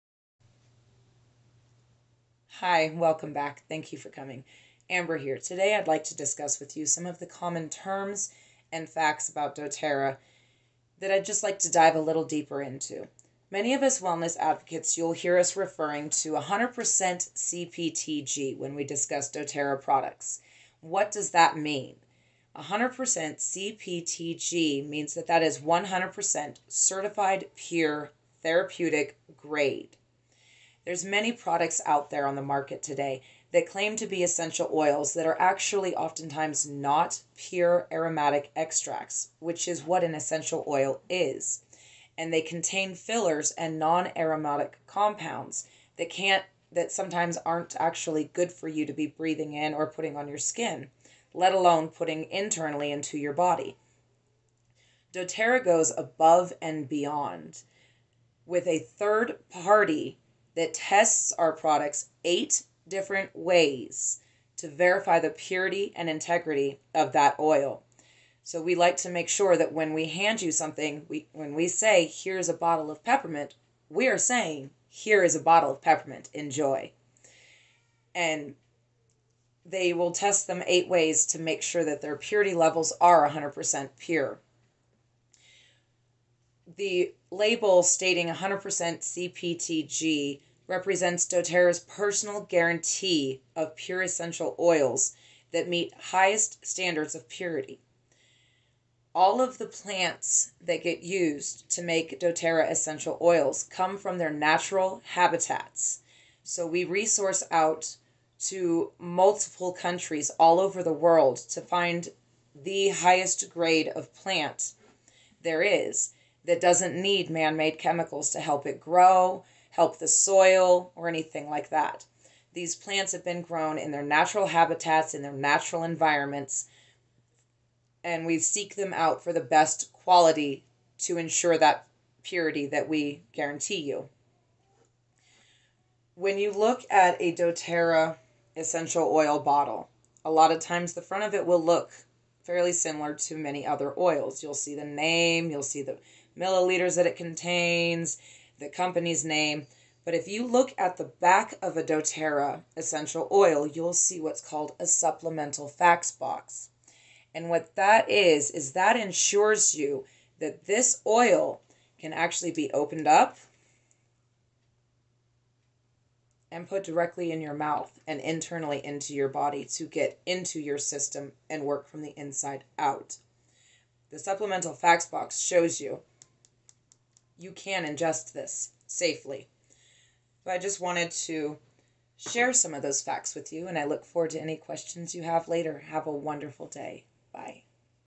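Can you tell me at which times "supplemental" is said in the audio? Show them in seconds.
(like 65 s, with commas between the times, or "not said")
154 s, 174 s.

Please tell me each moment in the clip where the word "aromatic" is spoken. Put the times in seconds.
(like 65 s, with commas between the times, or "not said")
37 s, 43 s.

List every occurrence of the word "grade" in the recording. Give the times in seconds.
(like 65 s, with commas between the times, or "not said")
29 s, 113 s.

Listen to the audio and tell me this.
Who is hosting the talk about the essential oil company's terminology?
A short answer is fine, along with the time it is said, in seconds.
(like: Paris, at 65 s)
Amber, at 4 s.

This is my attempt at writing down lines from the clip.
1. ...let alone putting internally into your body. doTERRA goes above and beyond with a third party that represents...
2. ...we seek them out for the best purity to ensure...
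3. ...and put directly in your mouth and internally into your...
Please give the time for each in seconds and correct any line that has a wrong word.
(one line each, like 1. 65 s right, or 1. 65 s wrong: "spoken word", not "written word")
1. 51 s wrong: "tests", not "represents"
2. 128 s wrong: "quality", not "purity"
3. 166 s right.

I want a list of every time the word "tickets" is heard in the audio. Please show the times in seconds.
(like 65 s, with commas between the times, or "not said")
not said.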